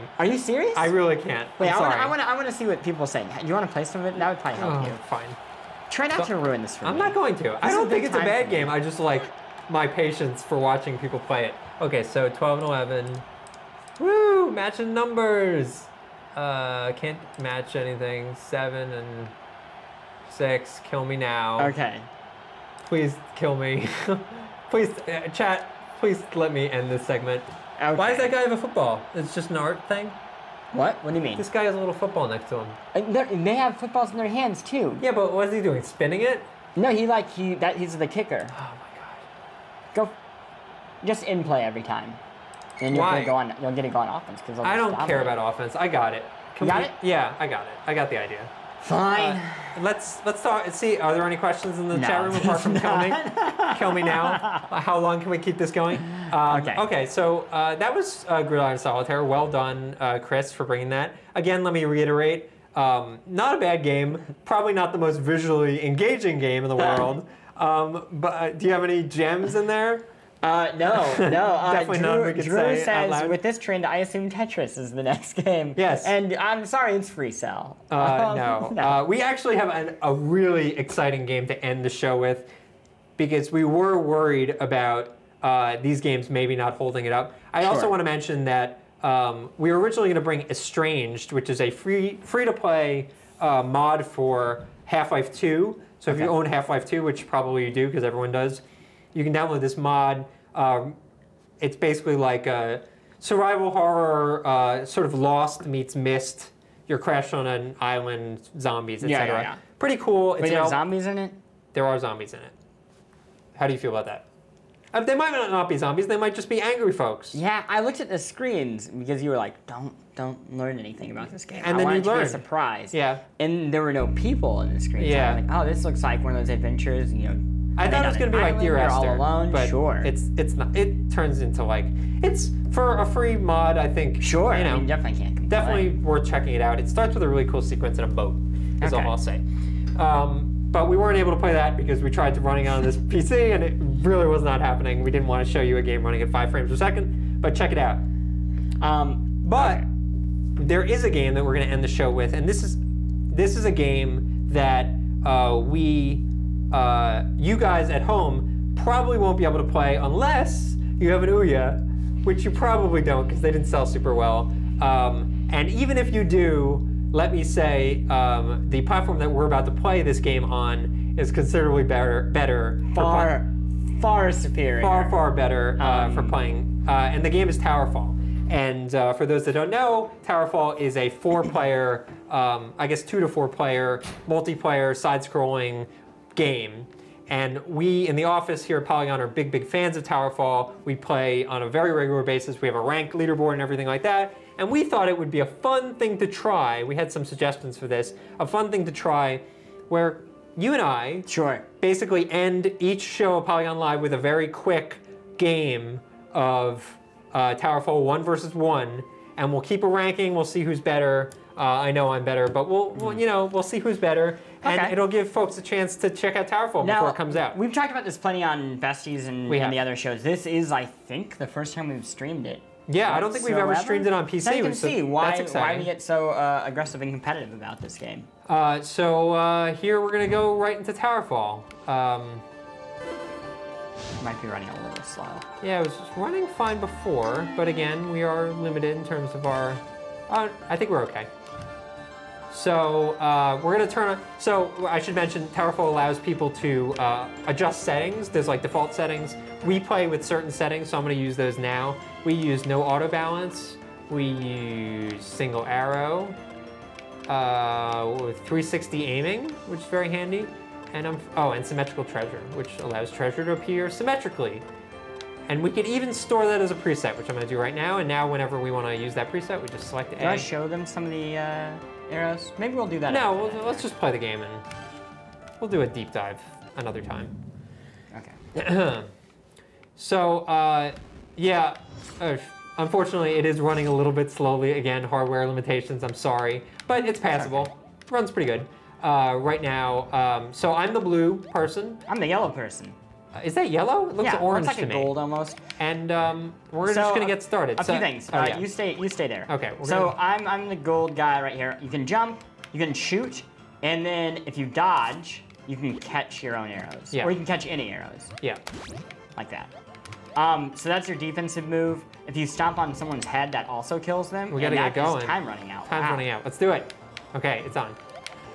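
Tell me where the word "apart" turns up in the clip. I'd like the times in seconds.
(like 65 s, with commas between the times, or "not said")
52 s.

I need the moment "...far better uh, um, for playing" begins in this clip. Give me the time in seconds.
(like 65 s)
175 s.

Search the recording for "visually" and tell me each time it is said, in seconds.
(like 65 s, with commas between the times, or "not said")
65 s.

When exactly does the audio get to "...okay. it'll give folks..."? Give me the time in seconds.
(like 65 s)
214 s.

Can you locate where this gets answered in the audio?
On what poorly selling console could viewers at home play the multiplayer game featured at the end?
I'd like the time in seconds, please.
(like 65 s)
161 s.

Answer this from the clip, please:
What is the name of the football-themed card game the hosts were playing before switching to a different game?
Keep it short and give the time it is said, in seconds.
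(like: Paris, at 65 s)
Gridiron Solitaire, at 58 s.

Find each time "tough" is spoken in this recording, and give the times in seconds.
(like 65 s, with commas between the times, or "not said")
not said.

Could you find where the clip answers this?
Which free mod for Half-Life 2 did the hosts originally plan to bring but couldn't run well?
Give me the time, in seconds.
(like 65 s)
90 s.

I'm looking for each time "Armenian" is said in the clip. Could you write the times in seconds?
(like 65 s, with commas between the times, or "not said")
not said.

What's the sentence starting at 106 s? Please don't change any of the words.
You're crashed on an island, zombies, etc.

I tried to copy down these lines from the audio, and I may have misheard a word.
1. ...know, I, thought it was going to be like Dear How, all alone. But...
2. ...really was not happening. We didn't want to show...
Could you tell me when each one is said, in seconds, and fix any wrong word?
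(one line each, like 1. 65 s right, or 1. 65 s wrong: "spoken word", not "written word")
1. 127 s wrong: "Esther", not "How"
2. 143 s right.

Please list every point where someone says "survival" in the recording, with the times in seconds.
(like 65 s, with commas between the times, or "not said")
103 s.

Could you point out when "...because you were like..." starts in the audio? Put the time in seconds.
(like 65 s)
118 s.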